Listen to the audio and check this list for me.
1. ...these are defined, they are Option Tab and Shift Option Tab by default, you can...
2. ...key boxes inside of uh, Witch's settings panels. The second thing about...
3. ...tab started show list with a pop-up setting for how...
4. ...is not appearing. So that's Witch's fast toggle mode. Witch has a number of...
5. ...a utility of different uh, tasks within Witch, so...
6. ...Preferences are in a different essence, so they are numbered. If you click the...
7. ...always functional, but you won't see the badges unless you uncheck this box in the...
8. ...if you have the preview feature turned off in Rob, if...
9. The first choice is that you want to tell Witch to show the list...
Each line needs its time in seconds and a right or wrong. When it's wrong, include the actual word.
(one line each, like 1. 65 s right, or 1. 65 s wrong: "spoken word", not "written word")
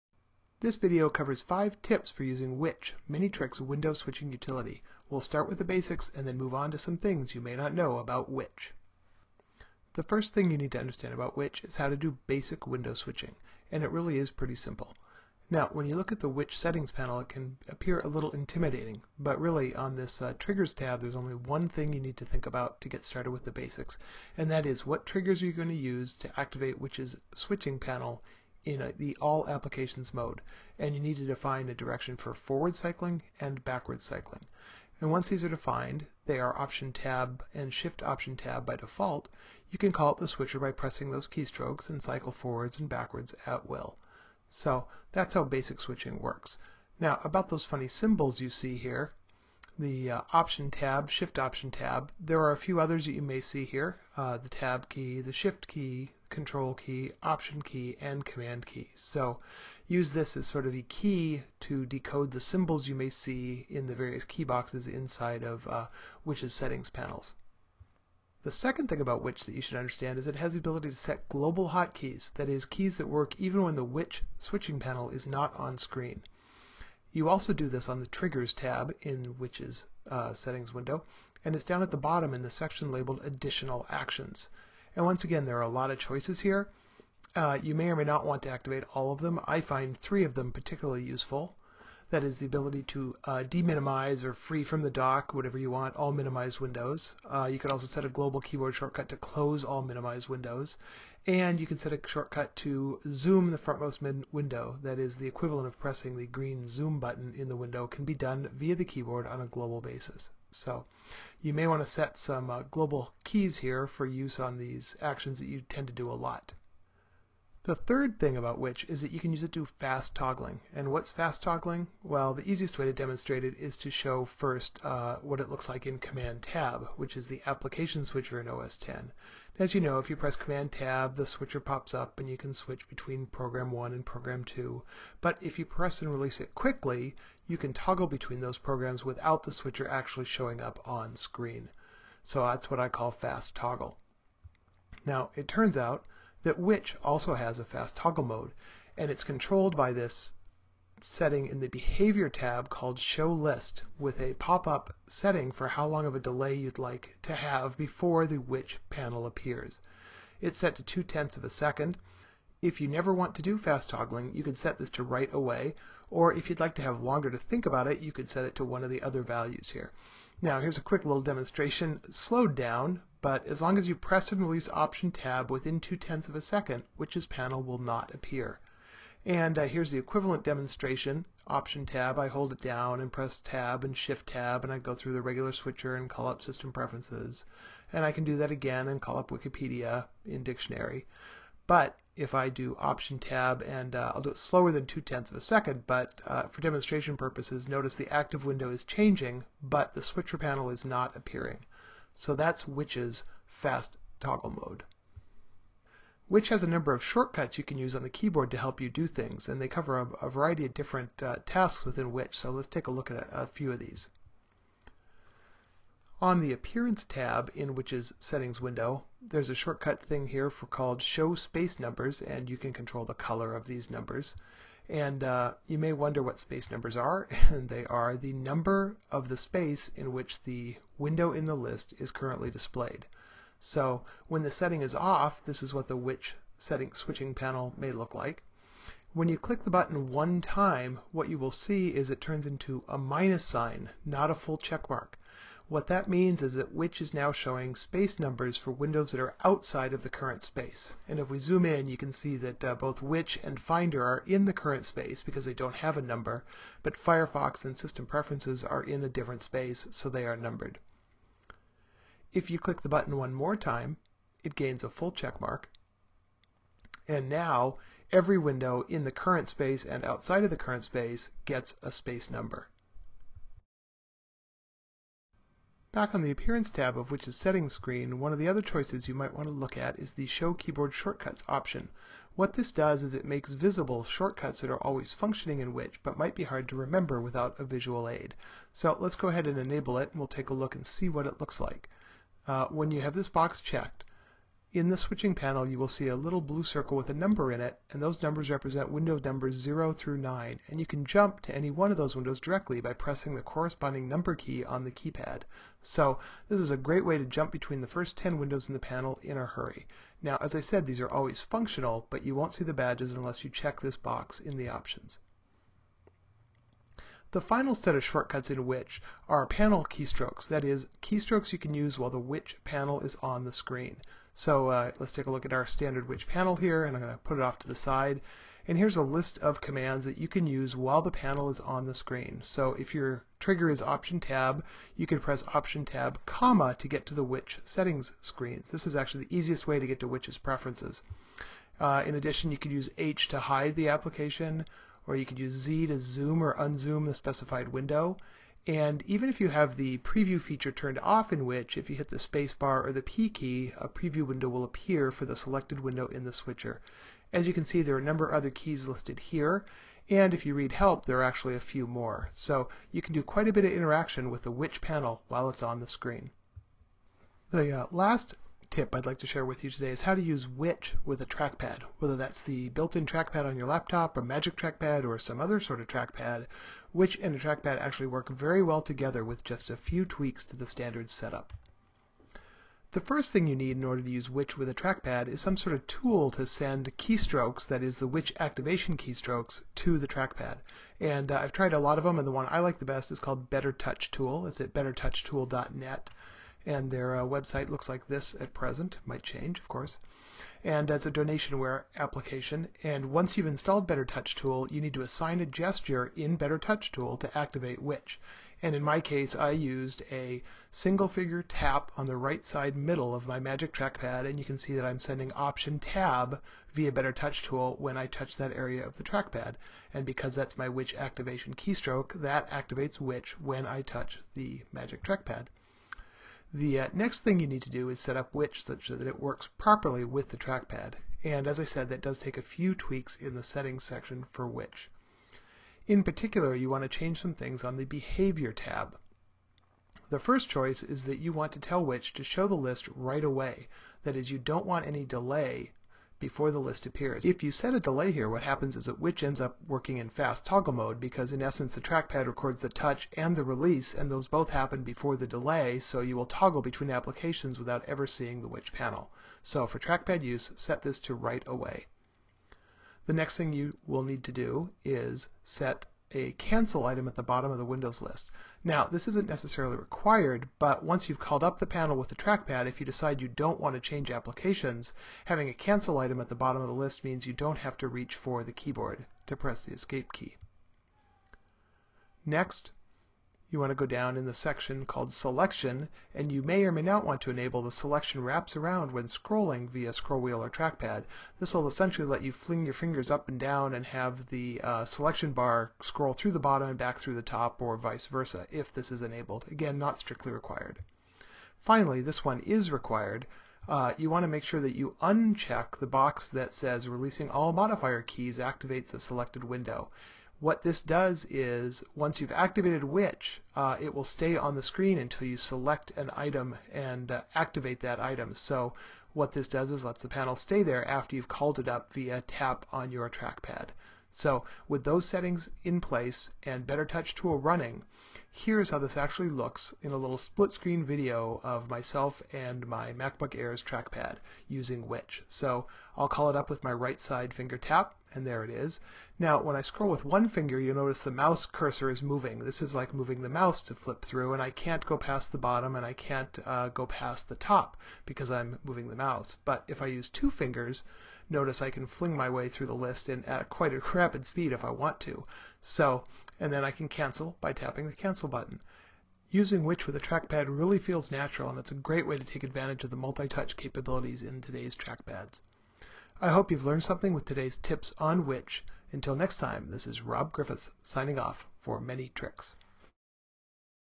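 1. 35 s right
2. 64 s right
3. 152 s wrong: "called", not "started"
4. 200 s right
5. 210 s wrong: "variety", not "utility"
6. 258 s wrong: "space", not "essence"
7. 311 s wrong: "check", not "uncheck"
8. 349 s wrong: "Witch", not "Rob"
9. 440 s right.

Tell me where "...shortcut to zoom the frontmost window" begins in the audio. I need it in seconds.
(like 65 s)
102 s.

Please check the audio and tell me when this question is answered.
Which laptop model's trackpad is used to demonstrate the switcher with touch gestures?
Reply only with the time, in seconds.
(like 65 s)
532 s.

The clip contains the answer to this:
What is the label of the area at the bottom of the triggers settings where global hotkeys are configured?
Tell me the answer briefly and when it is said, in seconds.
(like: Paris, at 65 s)
Additional Actions, at 83 s.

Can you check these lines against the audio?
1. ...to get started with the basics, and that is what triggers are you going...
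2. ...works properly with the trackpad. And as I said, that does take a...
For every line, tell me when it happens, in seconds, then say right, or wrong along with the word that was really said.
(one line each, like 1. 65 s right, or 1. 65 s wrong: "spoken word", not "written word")
1. 22 s right
2. 429 s right.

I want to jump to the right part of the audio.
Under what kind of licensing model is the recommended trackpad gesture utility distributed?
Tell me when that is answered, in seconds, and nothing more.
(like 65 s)
401 s.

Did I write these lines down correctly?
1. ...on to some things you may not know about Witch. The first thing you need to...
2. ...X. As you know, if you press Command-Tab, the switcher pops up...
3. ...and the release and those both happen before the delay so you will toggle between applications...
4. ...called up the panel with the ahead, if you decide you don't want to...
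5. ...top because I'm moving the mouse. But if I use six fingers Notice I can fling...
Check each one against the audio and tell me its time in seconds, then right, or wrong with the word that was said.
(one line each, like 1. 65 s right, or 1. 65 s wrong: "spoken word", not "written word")
1. 6 s right
2. 128 s right
3. 453 s right
4. 471 s wrong: "trackpad", not "ahead"
5. 547 s wrong: "two", not "six".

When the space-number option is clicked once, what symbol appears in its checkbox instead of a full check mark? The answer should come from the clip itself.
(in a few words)
minus sign.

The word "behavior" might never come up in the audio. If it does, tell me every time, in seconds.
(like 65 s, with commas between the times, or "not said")
151 s, 437 s.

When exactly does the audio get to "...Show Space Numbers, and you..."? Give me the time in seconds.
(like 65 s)
221 s.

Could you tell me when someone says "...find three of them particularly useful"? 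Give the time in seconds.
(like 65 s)
89 s.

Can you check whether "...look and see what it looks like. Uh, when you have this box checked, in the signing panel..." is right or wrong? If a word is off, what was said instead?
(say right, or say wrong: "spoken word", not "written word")
wrong: "switching", not "signing".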